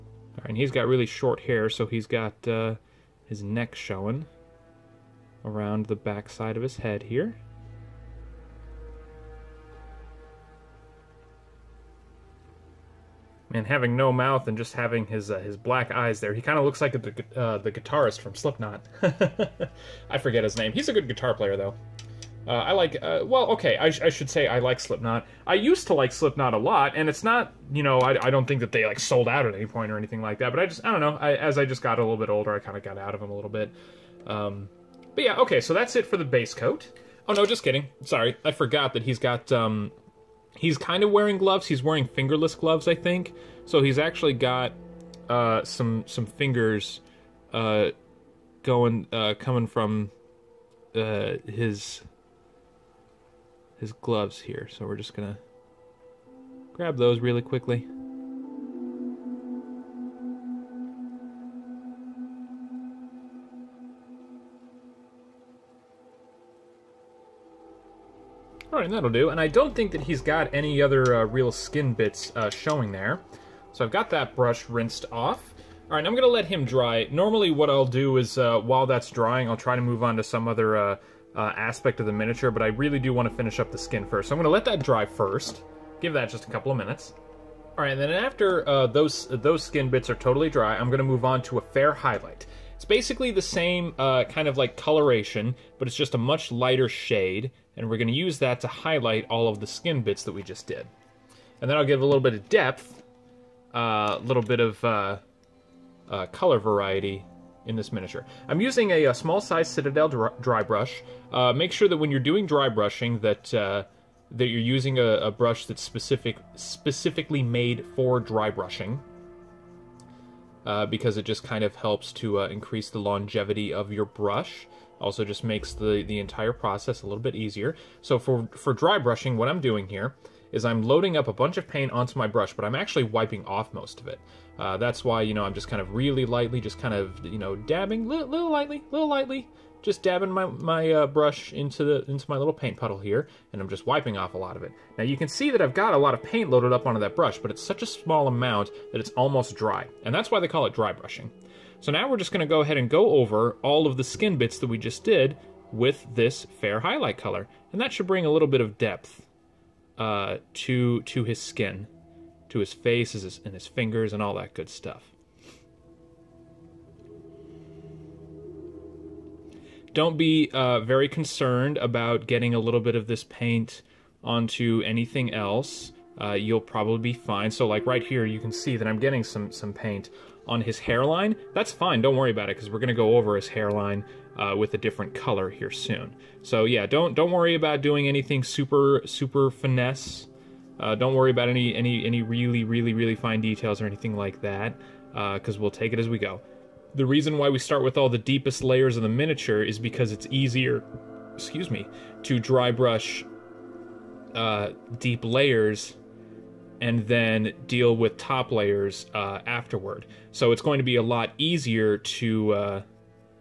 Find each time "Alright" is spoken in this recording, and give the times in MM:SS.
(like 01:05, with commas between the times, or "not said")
01:08, 01:15.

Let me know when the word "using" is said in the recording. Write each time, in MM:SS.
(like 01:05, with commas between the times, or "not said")
01:48, 01:54.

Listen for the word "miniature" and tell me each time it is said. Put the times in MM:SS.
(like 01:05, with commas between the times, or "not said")
01:22, 01:47, 03:19.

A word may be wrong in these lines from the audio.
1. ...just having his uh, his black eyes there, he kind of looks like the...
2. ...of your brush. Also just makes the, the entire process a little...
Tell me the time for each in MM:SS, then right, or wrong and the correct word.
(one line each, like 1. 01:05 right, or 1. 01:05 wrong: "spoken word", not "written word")
1. 00:14 right
2. 02:03 right.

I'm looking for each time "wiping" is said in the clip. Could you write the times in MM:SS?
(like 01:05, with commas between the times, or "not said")
02:13, 02:23.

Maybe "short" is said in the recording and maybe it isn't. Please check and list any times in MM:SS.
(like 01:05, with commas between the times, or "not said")
00:01.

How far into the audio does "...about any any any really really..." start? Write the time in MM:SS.
03:11.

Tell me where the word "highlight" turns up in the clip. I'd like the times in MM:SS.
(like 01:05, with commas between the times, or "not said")
01:31, 01:38, 02:36.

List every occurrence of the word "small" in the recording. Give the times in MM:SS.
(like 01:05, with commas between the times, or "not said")
01:49, 02:27.